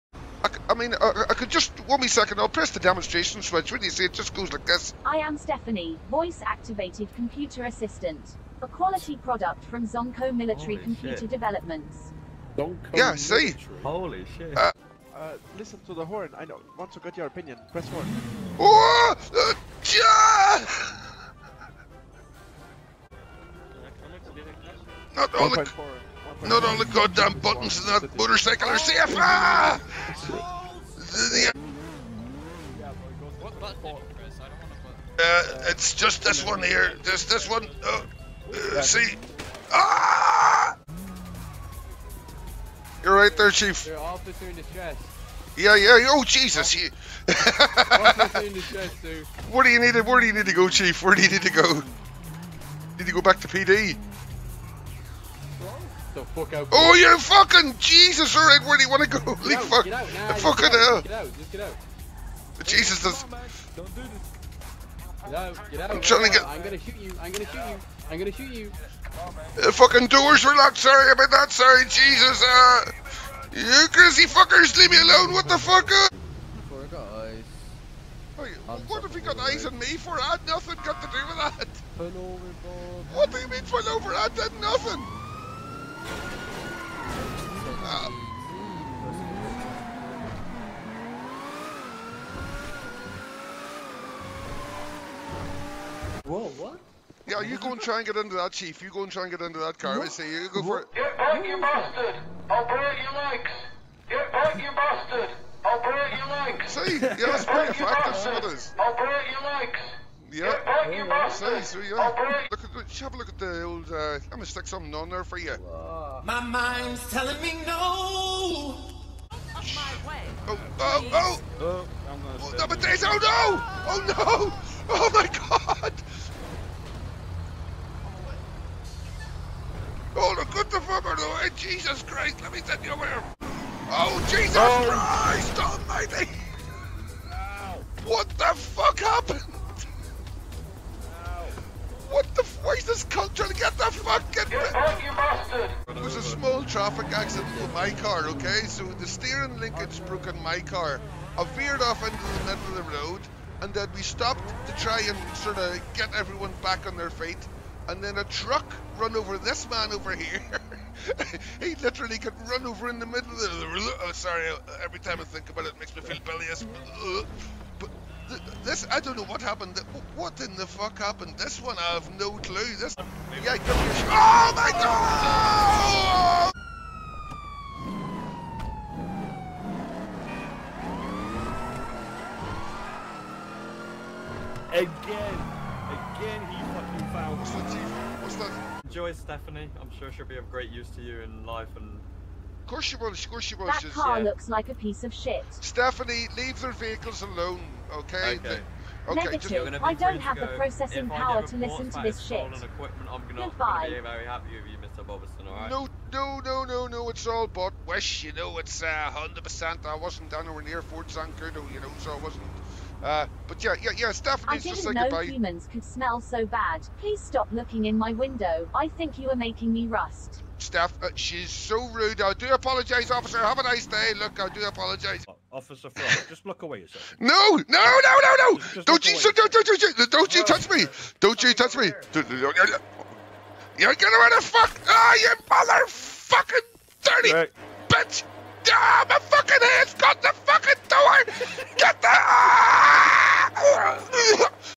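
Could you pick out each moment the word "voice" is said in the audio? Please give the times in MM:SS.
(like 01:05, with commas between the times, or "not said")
00:06.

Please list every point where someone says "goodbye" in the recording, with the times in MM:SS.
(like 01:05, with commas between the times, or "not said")
03:23, 03:35.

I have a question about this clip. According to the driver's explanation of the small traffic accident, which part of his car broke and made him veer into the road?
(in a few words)
Steering linkage.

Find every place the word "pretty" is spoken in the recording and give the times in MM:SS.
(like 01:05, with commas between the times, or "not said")
01:47.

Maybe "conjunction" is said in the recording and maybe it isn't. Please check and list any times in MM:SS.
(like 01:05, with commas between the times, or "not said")
not said.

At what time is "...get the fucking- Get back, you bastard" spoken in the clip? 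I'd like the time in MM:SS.
02:23.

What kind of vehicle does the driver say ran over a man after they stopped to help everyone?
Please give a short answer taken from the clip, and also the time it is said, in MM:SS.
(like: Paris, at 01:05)
Truck, at 02:38.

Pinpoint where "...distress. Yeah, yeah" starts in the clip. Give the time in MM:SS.
00:44.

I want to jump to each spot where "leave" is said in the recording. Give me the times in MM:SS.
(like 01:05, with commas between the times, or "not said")
01:14, 03:16.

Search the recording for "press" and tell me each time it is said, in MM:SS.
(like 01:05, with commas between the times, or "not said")
00:02, 00:17.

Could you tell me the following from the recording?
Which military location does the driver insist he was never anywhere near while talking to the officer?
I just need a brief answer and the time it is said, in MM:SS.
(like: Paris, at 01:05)
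Fort Zancudo, at 03:30.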